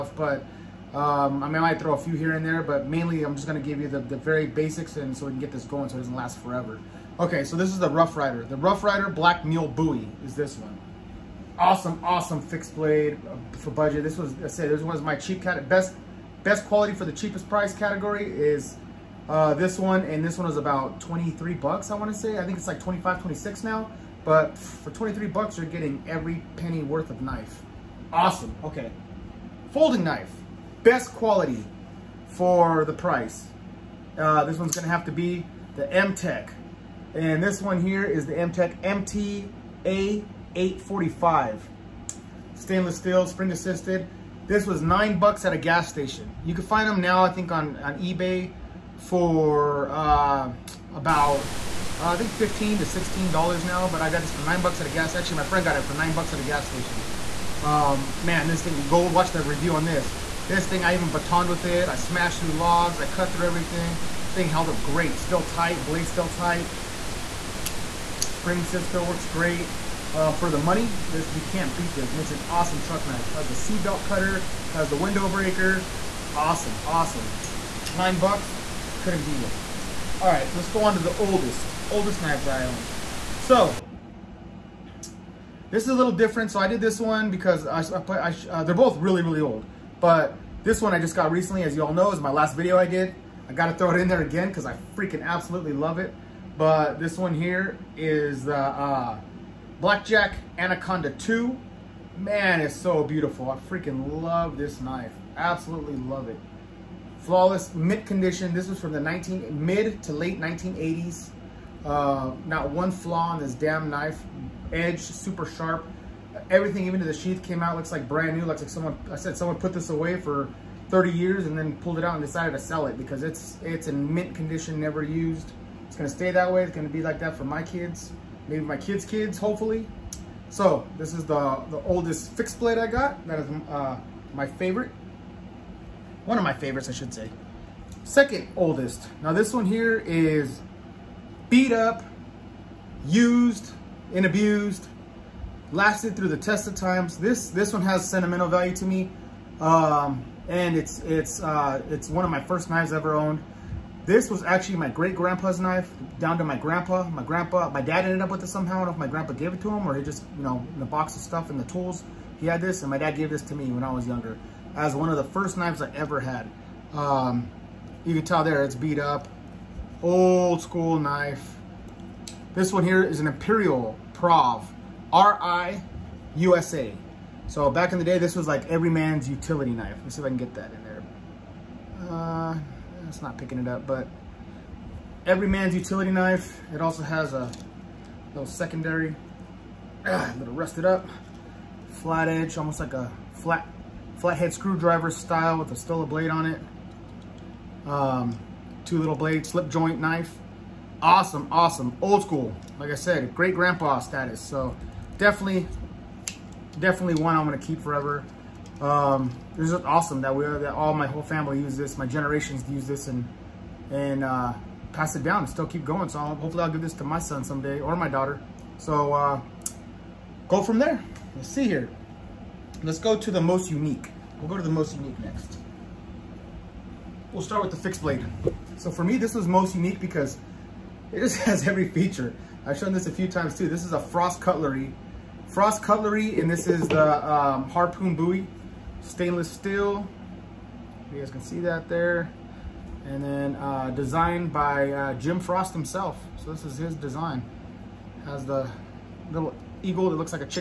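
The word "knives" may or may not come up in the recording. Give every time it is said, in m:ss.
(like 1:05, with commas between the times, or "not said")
1:22, 2:32, 2:45.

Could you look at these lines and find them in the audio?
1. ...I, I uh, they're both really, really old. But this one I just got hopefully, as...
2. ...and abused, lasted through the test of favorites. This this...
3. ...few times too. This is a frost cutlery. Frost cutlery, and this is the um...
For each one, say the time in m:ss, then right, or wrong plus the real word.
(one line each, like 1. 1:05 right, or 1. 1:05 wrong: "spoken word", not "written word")
1. 1:27 wrong: "recently", not "hopefully"
2. 2:24 wrong: "times", not "favorites"
3. 3:53 right.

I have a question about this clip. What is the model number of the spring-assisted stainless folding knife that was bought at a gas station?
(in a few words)
MTA 845.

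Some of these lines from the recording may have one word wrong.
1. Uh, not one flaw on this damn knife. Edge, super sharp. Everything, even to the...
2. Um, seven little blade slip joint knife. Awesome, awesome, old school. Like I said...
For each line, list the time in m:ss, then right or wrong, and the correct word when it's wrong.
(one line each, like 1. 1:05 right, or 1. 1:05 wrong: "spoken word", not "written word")
1. 1:51 right
2. 3:17 wrong: "two", not "seven".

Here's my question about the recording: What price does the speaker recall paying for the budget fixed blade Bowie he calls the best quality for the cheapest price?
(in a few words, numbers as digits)
$23.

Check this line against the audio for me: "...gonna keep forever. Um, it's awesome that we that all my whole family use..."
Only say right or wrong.
right.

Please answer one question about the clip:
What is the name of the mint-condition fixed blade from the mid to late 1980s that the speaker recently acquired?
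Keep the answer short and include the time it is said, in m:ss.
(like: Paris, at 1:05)
Blackjack Anaconda 2, at 1:39.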